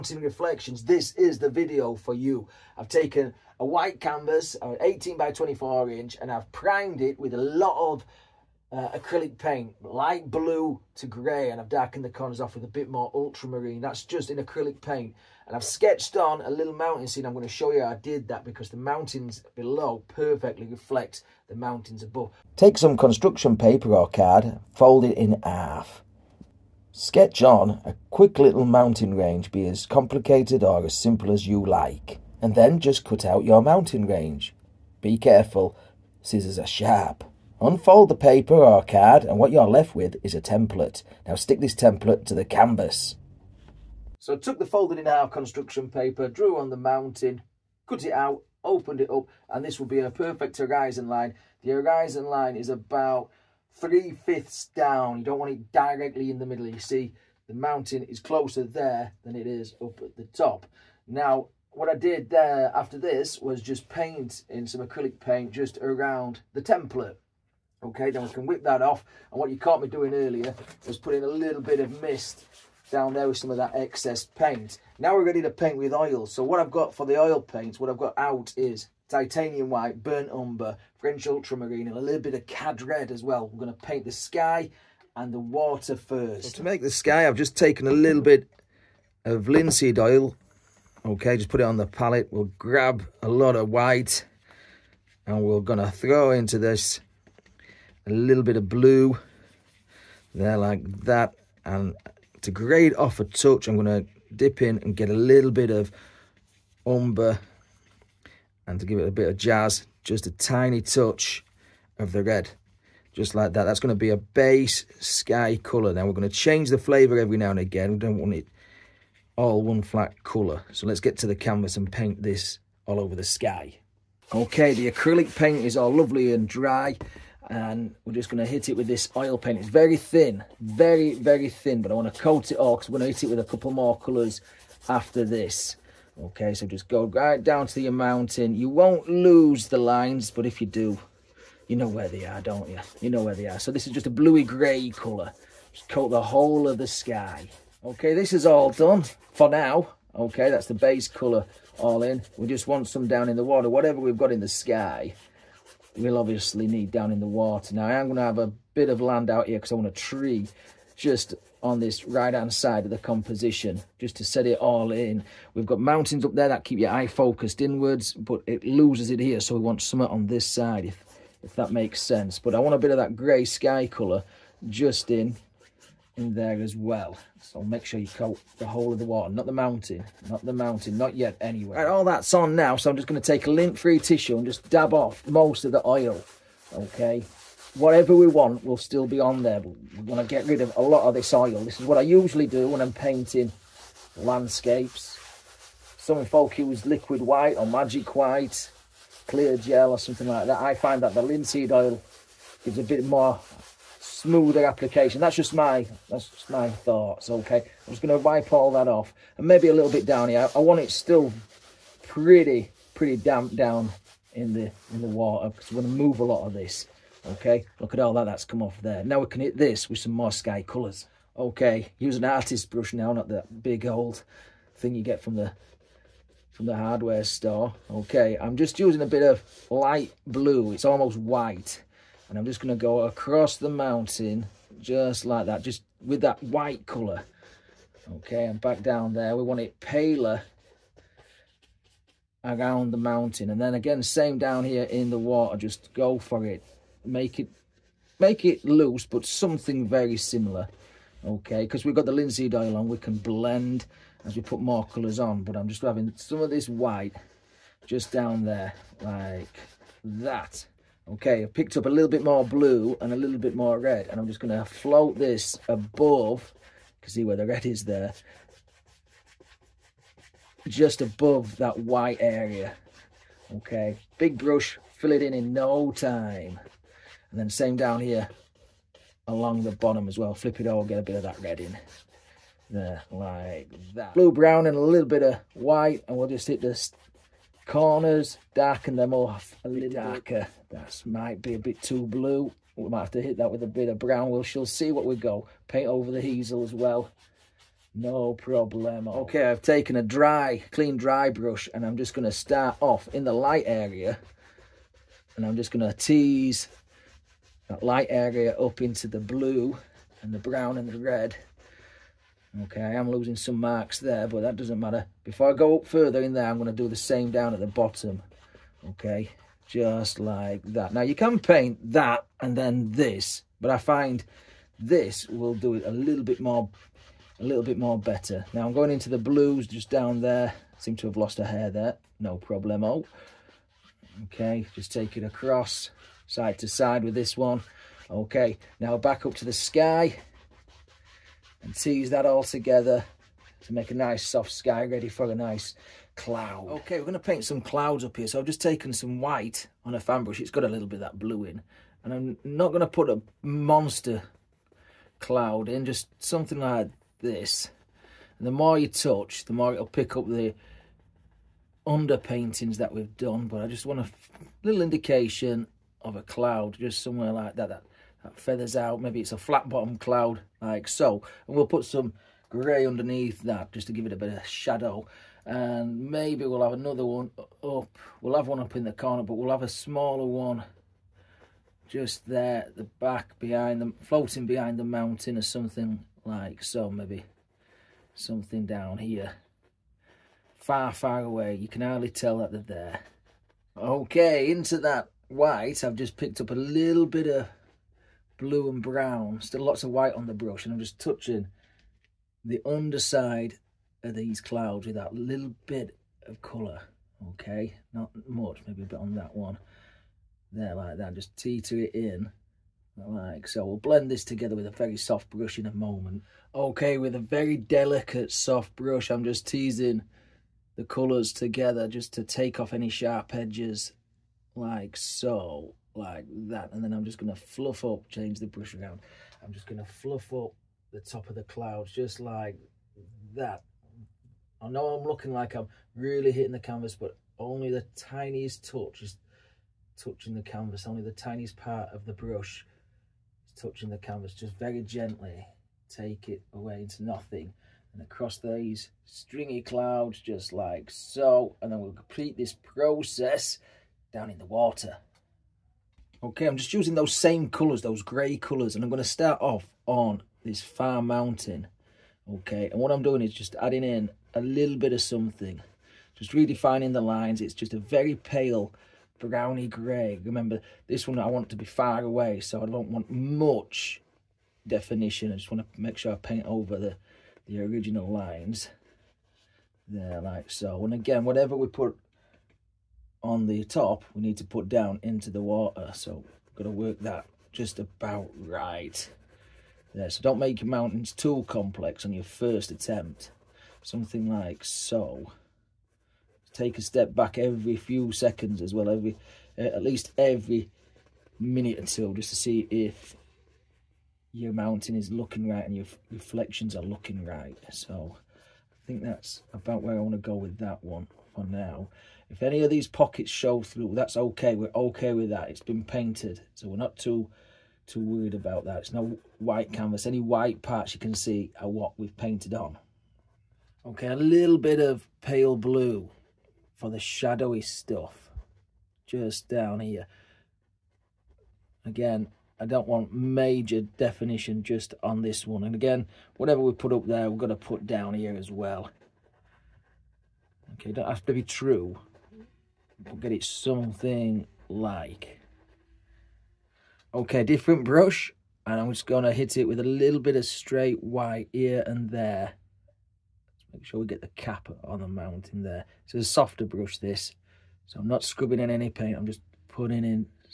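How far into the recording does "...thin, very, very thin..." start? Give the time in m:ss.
2:09.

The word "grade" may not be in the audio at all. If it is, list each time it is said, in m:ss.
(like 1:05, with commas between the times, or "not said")
1:42.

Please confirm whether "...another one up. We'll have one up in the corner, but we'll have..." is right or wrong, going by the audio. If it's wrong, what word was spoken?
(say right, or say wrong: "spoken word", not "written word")
right.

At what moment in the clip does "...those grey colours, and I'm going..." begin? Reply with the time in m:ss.
7:37.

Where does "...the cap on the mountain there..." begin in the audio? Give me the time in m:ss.
9:14.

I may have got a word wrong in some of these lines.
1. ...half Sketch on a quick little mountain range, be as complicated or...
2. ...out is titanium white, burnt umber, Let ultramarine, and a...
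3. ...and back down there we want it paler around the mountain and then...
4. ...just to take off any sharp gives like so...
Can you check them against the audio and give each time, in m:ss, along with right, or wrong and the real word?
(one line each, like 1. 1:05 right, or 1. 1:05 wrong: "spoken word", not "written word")
1. 0:25 right
2. 1:18 wrong: "French", not "Let"
3. 3:58 right
4. 7:01 wrong: "edges", not "gives".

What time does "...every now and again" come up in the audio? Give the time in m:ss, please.
1:57.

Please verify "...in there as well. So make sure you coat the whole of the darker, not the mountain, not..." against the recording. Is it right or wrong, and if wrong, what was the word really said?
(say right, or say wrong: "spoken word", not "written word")
wrong: "water", not "darker".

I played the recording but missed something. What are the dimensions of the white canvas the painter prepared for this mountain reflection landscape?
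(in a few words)
18 by 24 inch.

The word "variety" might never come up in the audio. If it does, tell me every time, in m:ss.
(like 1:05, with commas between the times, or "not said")
not said.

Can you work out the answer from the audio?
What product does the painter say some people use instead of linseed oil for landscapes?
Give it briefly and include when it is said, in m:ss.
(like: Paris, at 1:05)
liquid white, at 3:16.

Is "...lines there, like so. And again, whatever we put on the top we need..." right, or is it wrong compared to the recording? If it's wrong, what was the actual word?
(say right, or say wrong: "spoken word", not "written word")
right.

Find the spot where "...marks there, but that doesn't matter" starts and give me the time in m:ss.
5:13.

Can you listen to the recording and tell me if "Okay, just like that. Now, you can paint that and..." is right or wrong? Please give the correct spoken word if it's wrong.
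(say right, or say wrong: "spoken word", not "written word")
right.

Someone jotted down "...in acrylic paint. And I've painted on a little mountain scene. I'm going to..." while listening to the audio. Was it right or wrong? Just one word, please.
wrong.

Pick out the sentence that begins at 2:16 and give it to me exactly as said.
Okay, so just go right down to your mountain.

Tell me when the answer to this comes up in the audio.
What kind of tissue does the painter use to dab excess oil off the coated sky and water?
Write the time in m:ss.
3:03.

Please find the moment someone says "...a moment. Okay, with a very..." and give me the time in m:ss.
6:55.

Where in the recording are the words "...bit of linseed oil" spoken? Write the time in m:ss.
1:28.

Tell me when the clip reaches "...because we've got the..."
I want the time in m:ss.
4:11.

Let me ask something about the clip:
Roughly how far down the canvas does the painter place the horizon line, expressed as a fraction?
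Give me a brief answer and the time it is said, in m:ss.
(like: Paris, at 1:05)
three-fifths, at 0:53.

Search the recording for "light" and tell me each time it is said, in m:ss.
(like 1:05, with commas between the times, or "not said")
0:09, 3:49, 5:03, 5:07.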